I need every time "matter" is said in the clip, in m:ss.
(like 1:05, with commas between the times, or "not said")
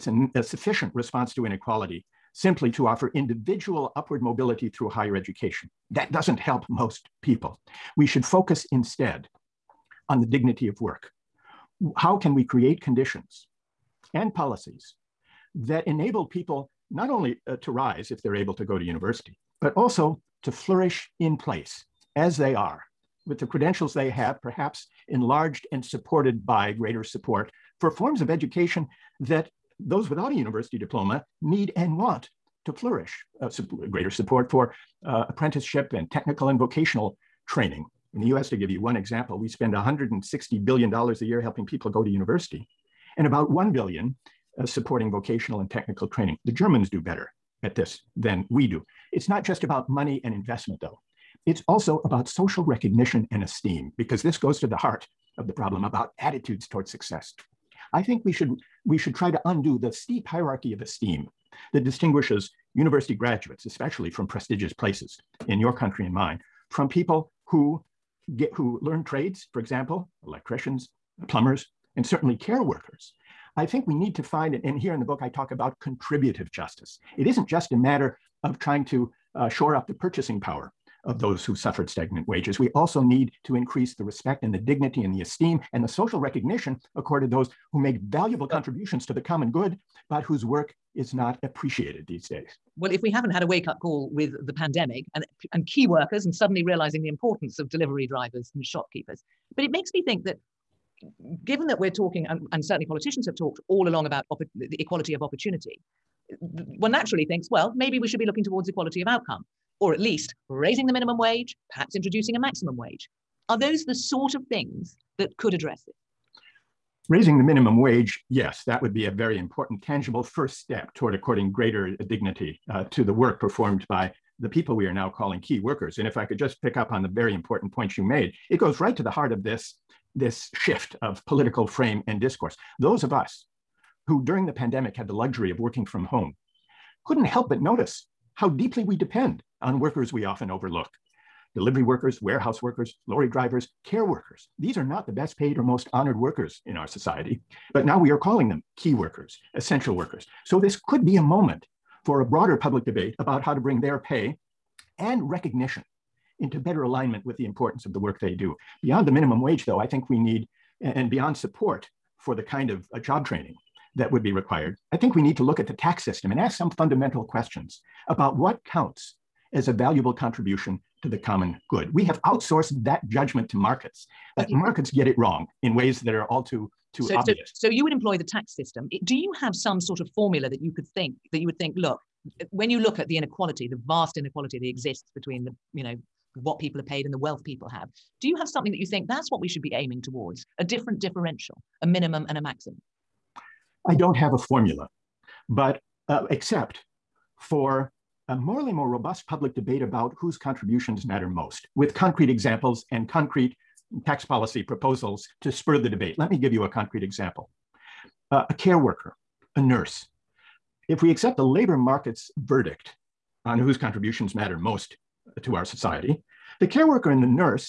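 1:17, 3:21, 3:34.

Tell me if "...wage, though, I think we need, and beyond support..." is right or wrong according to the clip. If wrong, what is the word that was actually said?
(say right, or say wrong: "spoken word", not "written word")
right.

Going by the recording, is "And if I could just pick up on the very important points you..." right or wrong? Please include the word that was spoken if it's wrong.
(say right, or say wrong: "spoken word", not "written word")
right.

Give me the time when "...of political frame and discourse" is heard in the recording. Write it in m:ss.
2:11.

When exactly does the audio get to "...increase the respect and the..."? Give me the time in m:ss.
1:23.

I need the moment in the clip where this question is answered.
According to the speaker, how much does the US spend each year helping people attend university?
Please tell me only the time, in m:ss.
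0:39.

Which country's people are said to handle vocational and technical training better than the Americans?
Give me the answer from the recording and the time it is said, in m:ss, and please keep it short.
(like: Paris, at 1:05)
The Germans, at 0:46.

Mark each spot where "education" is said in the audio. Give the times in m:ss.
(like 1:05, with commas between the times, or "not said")
0:05, 0:28.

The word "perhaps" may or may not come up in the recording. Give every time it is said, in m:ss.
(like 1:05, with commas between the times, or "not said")
0:24, 1:51.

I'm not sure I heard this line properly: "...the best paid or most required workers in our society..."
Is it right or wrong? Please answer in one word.
wrong.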